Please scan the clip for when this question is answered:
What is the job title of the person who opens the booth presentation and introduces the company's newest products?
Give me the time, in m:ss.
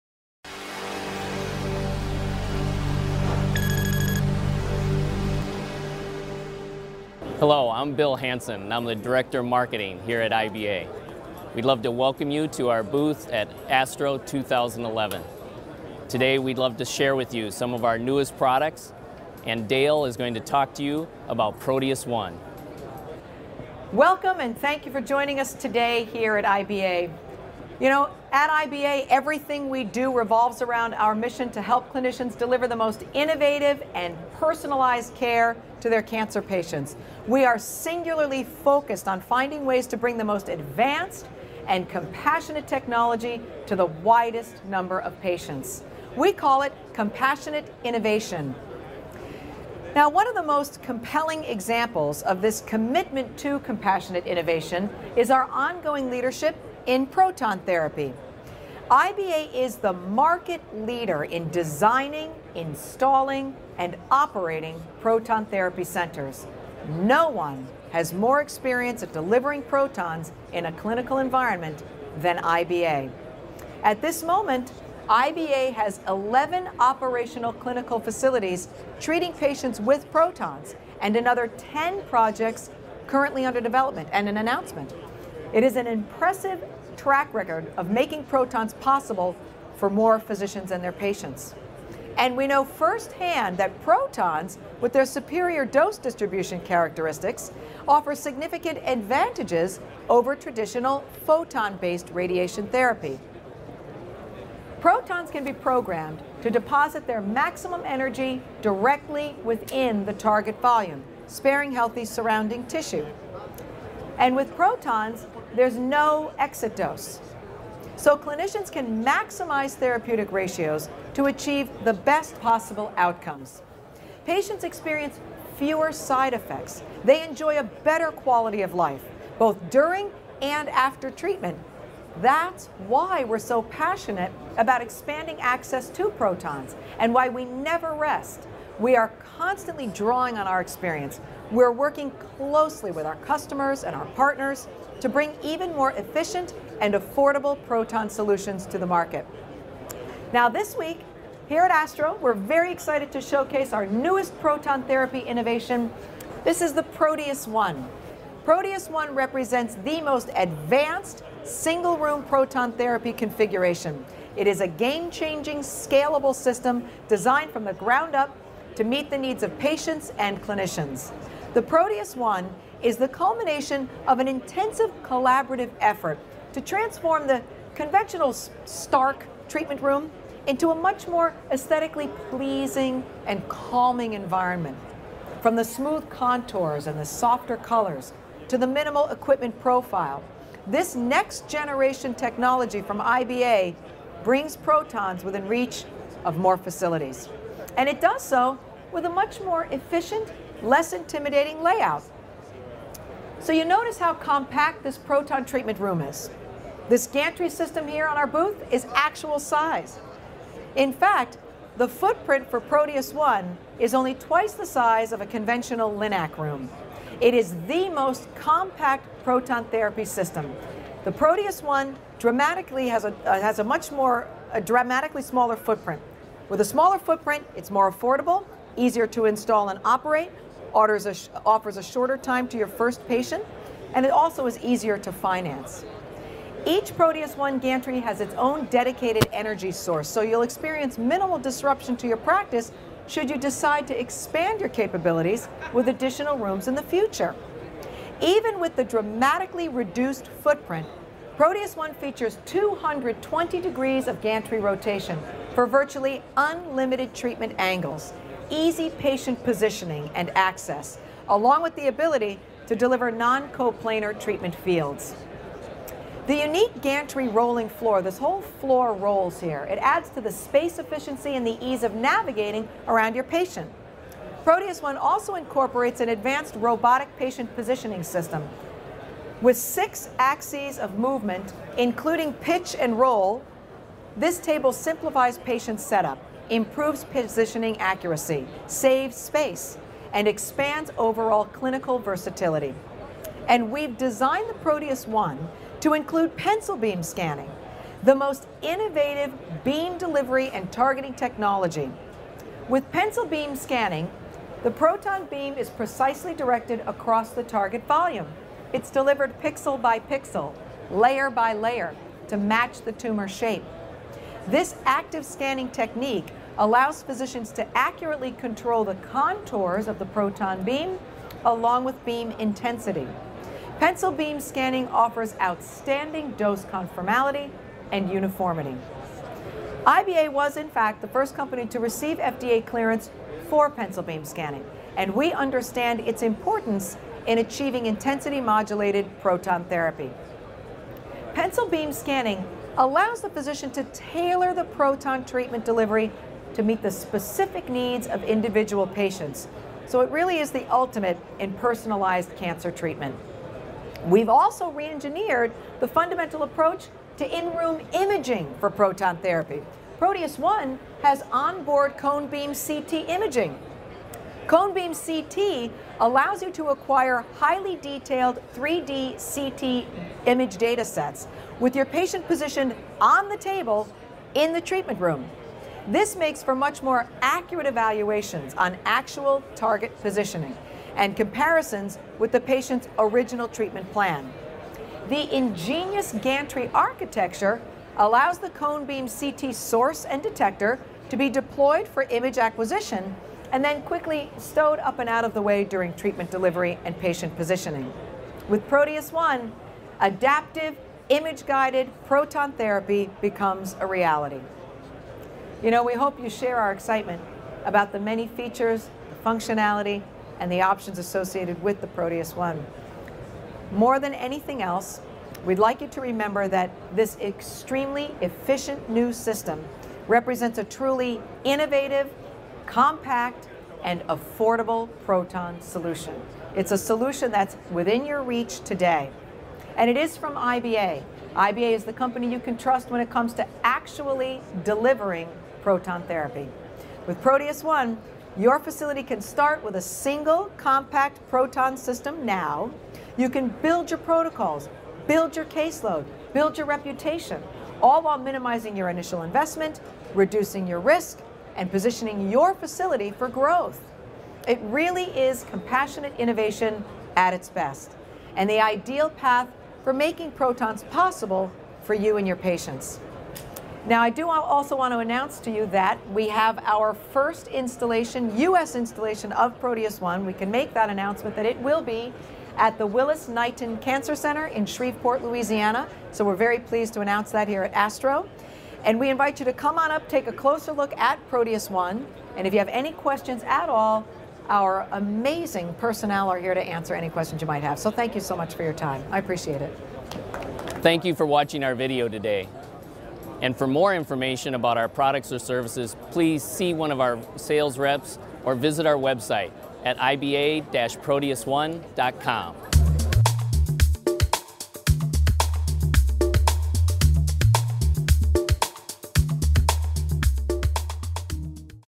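0:08.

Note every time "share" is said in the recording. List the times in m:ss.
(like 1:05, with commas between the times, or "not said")
0:16, 6:46.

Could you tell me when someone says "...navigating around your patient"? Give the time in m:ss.
4:31.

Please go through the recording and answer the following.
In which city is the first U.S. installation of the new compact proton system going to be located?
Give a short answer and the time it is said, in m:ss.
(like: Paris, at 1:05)
Shreveport, Louisiana, at 7:54.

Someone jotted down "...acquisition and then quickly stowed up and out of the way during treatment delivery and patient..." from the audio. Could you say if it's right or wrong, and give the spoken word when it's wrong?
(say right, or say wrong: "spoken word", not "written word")
right.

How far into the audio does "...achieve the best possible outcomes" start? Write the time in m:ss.
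2:01.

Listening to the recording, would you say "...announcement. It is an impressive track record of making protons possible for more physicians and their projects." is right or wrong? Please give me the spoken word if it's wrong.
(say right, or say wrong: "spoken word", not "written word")
wrong: "patients", not "projects".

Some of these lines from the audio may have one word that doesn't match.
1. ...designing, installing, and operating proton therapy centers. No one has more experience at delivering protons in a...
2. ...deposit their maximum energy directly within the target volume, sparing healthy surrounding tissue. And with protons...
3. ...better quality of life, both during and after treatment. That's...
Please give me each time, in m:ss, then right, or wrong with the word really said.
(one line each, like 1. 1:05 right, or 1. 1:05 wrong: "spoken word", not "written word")
1. 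1:01 right
2. 1:46 right
3. 2:07 right.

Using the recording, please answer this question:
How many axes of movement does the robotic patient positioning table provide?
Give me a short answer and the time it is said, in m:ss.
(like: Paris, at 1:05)
six, at 4:39.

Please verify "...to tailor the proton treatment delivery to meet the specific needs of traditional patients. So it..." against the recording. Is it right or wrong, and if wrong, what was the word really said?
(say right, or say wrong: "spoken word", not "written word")
wrong: "individual", not "traditional".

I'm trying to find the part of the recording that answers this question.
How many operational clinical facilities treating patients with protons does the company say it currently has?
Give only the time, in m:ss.
1:16.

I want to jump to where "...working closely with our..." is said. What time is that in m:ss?
2:21.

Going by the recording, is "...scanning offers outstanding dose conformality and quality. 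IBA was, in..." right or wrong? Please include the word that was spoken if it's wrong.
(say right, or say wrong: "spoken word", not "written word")
wrong: "uniformity", not "quality".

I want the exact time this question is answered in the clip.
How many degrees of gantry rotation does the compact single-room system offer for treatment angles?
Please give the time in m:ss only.
4:12.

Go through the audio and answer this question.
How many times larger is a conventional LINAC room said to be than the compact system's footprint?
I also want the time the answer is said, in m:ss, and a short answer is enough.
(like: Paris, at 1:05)
twice, at 3:34.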